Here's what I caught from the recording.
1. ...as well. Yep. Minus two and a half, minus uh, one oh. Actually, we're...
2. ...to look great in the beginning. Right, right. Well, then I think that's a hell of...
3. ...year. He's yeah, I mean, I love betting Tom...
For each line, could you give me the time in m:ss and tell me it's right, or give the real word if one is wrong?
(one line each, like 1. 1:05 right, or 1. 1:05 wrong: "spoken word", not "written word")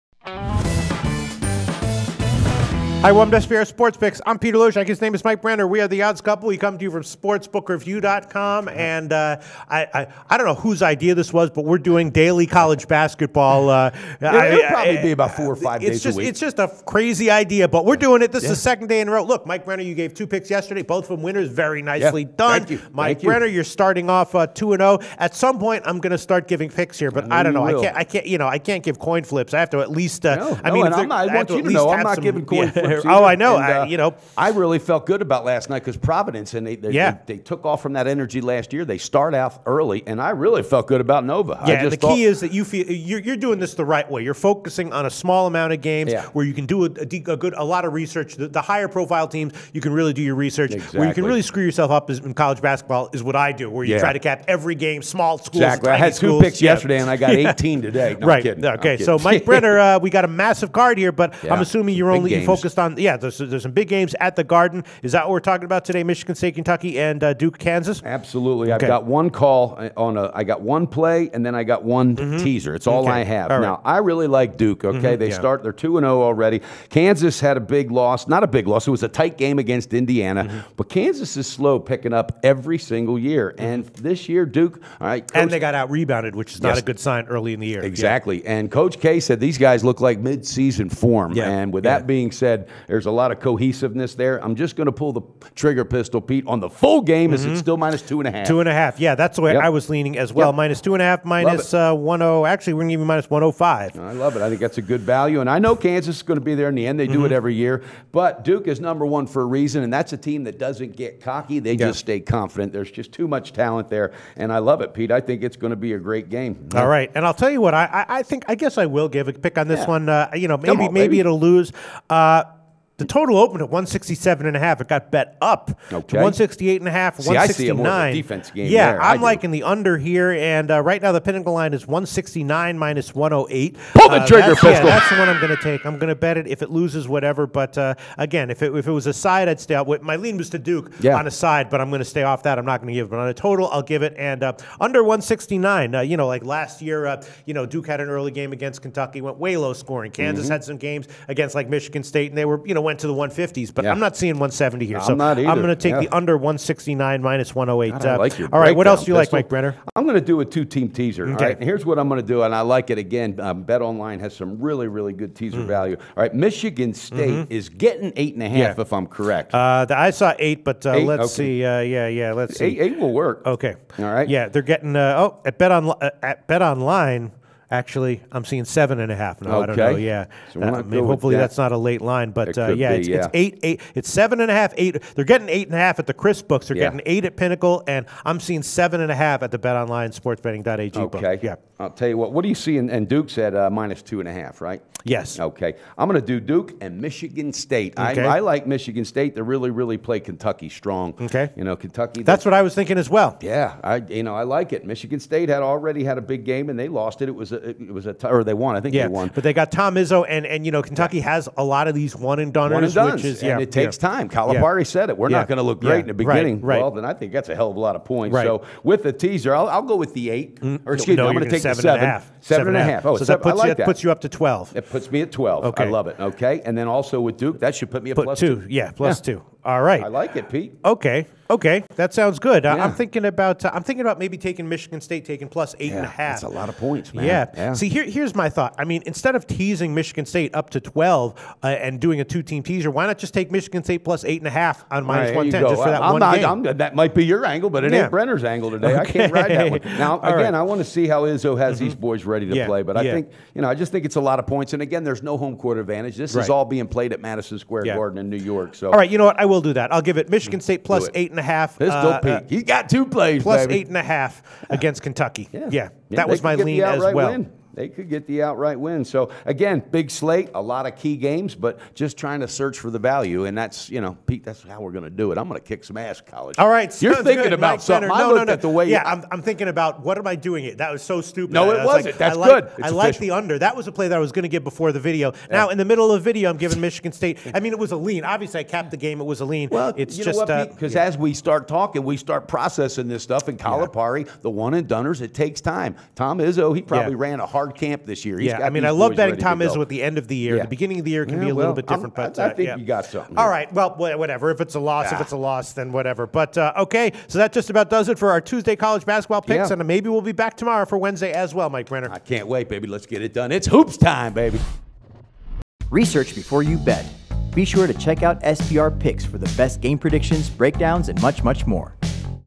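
1. 1:40 right
2. 3:35 right
3. 4:58 right.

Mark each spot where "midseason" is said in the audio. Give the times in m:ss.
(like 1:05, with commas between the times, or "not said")
1:30.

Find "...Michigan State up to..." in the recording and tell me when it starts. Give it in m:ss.
3:59.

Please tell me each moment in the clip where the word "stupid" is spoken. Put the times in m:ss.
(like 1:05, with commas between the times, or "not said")
4:41.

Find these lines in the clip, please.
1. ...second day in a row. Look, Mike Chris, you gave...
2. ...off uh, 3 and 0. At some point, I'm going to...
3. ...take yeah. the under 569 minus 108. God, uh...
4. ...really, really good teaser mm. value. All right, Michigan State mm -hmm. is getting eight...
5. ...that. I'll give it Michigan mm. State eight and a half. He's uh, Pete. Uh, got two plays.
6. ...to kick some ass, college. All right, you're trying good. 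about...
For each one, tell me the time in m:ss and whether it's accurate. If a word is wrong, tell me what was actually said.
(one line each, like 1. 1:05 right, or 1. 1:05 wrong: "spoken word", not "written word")
1. 0:18 wrong: "Brenner", not "Chris"
2. 0:24 wrong: "2", not "3"
3. 2:35 wrong: "169", not "569"
4. 2:44 right
5. 4:19 right
6. 4:35 wrong: "thinking", not "trying".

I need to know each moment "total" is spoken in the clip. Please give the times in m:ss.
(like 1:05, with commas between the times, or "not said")
2:03, 2:23.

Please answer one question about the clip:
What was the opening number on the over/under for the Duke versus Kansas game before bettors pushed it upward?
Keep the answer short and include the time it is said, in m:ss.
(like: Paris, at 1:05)
167.5, at 2:03.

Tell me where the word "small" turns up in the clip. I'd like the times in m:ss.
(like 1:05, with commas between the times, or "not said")
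0:45, 0:55.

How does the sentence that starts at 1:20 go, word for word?
but Kansas is slow picking up every single year.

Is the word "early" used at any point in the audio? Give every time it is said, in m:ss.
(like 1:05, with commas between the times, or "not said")
0:39, 1:27, 2:28.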